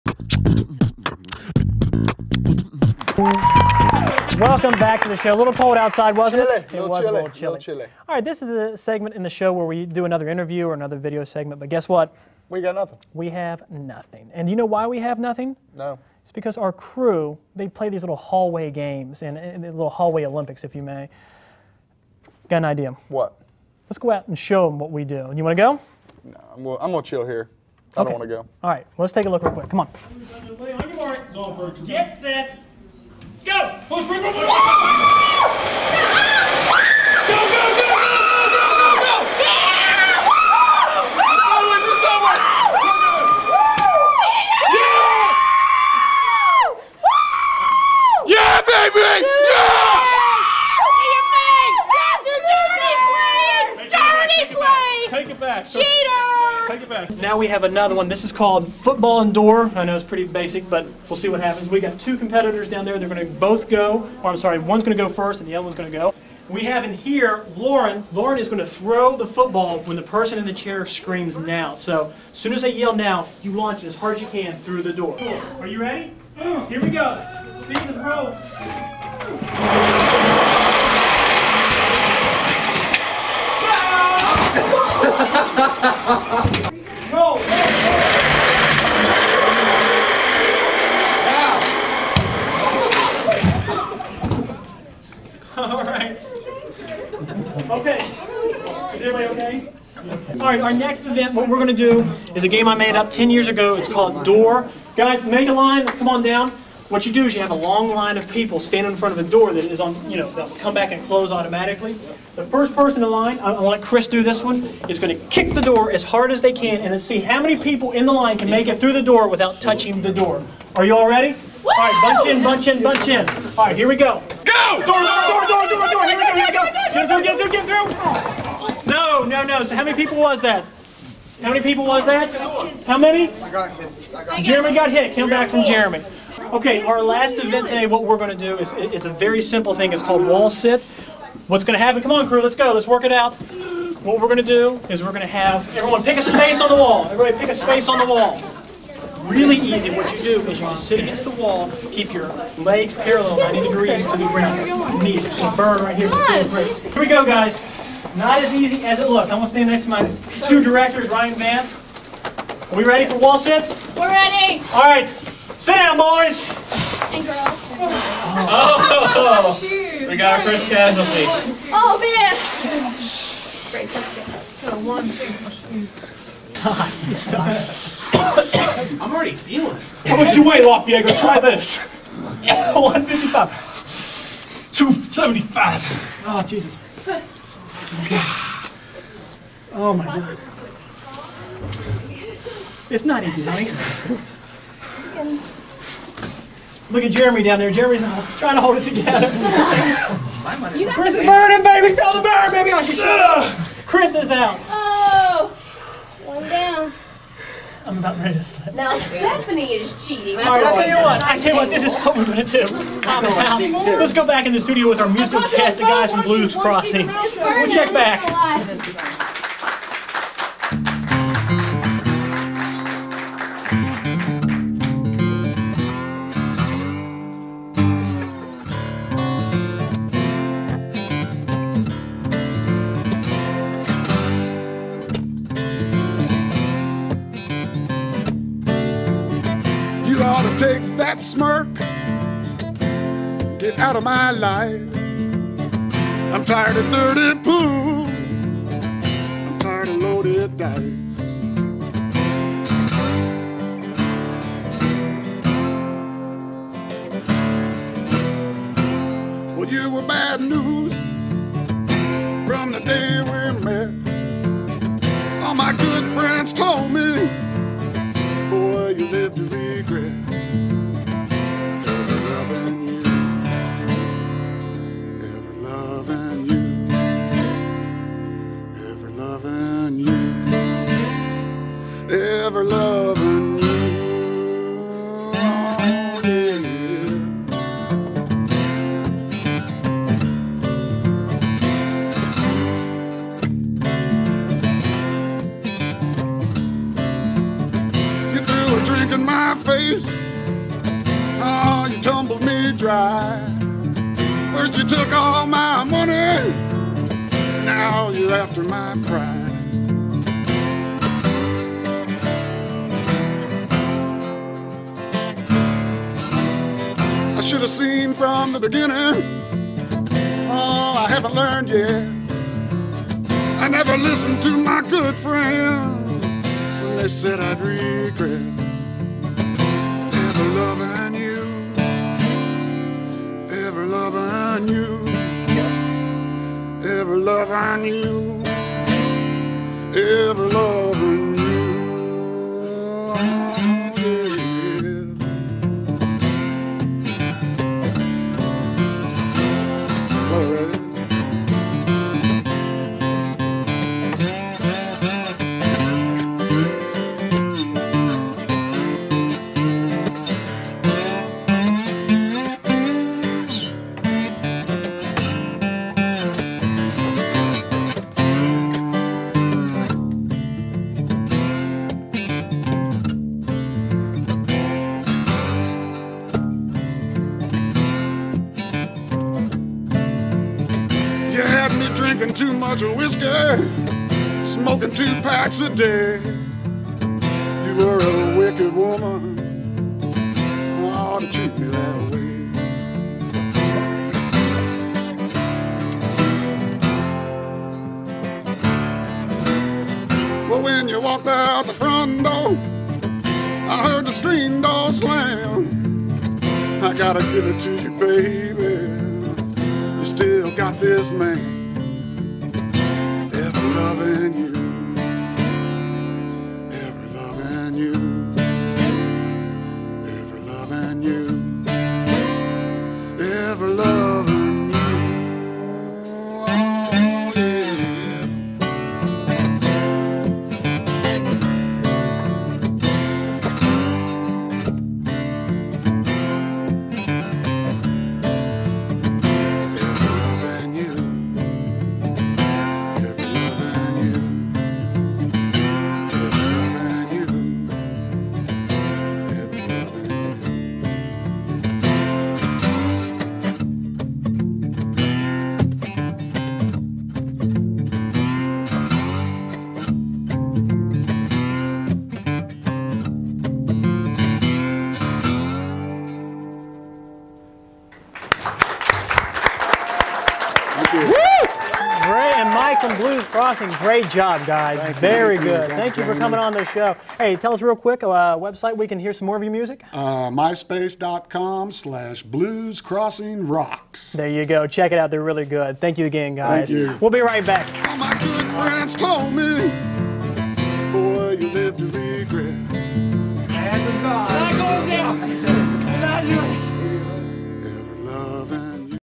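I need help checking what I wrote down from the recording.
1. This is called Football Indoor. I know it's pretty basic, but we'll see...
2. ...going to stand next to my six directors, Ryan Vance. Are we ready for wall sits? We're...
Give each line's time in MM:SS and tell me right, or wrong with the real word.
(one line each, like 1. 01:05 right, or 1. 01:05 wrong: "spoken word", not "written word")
1. 00:58 right
2. 02:39 wrong: "two", not "six".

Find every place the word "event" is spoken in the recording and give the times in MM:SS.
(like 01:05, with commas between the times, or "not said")
01:41, 02:17.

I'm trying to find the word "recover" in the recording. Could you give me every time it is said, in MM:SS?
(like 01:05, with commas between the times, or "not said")
not said.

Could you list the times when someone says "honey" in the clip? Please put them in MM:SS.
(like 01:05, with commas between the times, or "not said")
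03:13.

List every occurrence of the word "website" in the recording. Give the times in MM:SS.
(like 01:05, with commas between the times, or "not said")
07:58.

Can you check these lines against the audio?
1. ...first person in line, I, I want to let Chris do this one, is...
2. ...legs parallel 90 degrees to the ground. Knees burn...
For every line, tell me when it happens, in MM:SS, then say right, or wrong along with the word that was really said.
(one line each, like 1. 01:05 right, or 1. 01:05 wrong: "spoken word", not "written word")
1. 01:52 right
2. 02:32 right.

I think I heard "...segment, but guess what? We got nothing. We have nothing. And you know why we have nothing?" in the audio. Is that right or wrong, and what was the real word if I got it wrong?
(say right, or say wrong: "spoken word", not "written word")
right.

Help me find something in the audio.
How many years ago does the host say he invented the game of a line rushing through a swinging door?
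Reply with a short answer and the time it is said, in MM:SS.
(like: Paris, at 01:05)
10 years, at 01:43.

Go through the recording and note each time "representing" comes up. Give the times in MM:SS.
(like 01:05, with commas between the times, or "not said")
not said.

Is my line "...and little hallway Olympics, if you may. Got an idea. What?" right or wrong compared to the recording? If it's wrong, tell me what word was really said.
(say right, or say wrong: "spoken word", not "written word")
right.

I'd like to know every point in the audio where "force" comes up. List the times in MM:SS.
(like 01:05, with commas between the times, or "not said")
not said.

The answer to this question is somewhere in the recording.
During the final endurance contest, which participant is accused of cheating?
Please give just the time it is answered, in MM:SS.
03:28.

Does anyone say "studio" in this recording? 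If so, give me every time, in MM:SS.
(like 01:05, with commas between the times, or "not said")
03:34.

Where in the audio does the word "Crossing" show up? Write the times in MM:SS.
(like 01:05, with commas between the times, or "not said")
03:36, 07:53, 08:02.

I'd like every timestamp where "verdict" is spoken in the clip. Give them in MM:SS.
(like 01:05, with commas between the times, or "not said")
not said.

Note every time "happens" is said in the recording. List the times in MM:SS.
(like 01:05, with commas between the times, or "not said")
01:01, 02:21.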